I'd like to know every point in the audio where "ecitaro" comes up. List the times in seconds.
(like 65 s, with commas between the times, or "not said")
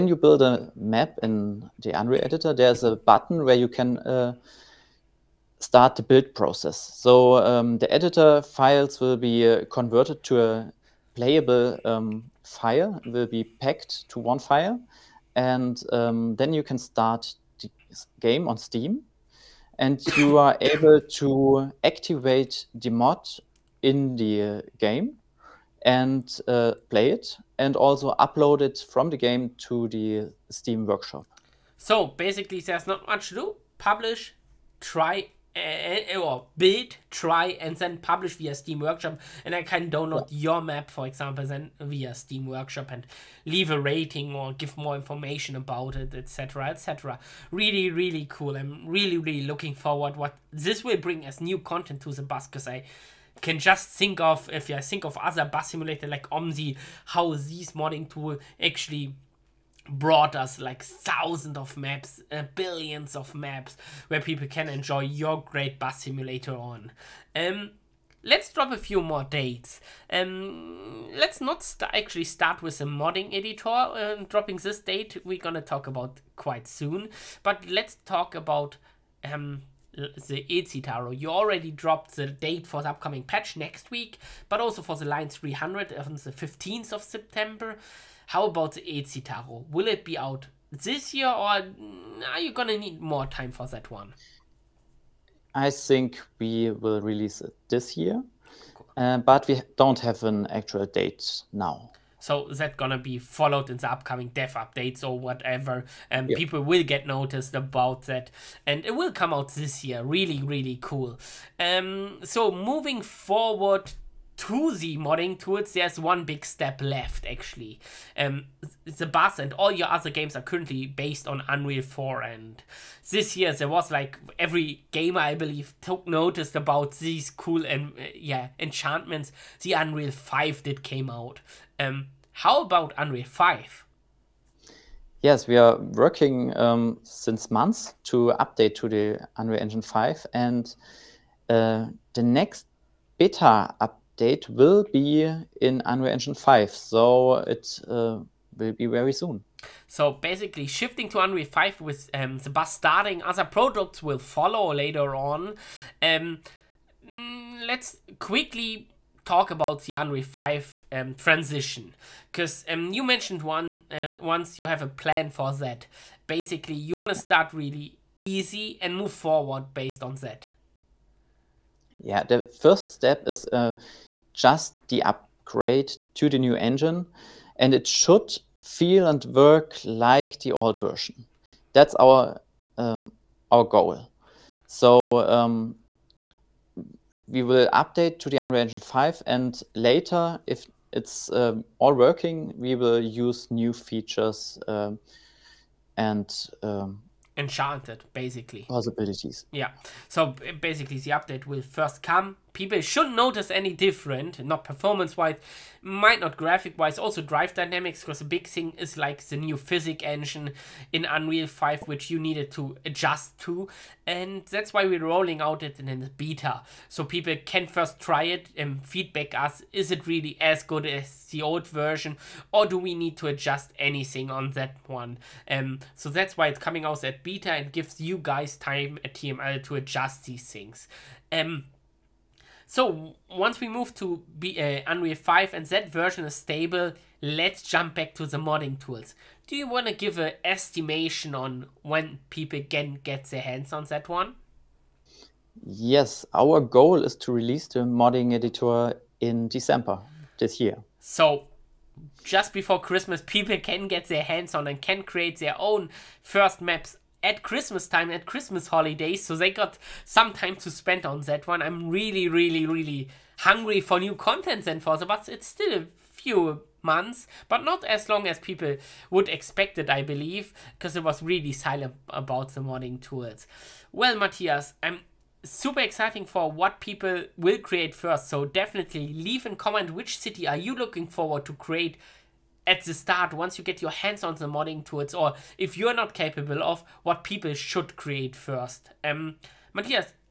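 80 s, 88 s.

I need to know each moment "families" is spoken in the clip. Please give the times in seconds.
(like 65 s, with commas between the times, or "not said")
not said.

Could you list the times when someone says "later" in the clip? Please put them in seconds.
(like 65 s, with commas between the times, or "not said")
154 s, 189 s.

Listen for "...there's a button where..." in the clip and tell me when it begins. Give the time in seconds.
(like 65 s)
2 s.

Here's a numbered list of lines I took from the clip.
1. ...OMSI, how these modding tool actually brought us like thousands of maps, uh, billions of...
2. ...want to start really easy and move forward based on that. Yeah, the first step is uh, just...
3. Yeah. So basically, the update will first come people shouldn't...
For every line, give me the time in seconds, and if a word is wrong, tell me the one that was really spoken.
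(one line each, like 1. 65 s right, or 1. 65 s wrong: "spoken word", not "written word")
1. 56 s right
2. 166 s right
3. 199 s right.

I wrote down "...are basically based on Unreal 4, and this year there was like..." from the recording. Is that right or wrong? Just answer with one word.
wrong.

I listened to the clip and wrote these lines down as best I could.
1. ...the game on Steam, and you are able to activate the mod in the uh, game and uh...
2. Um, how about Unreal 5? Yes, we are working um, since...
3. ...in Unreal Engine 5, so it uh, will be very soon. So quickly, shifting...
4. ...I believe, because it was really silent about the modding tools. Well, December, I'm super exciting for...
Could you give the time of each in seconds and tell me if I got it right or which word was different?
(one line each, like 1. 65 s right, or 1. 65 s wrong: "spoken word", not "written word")
1. 17 s right
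2. 131 s right
3. 145 s wrong: "basically", not "quickly"
4. 269 s wrong: "Mathias", not "December".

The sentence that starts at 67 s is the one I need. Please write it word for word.
Um, let's drop a few more dates.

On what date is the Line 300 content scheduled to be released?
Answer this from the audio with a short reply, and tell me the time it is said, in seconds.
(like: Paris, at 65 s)
15th of September, at 86 s.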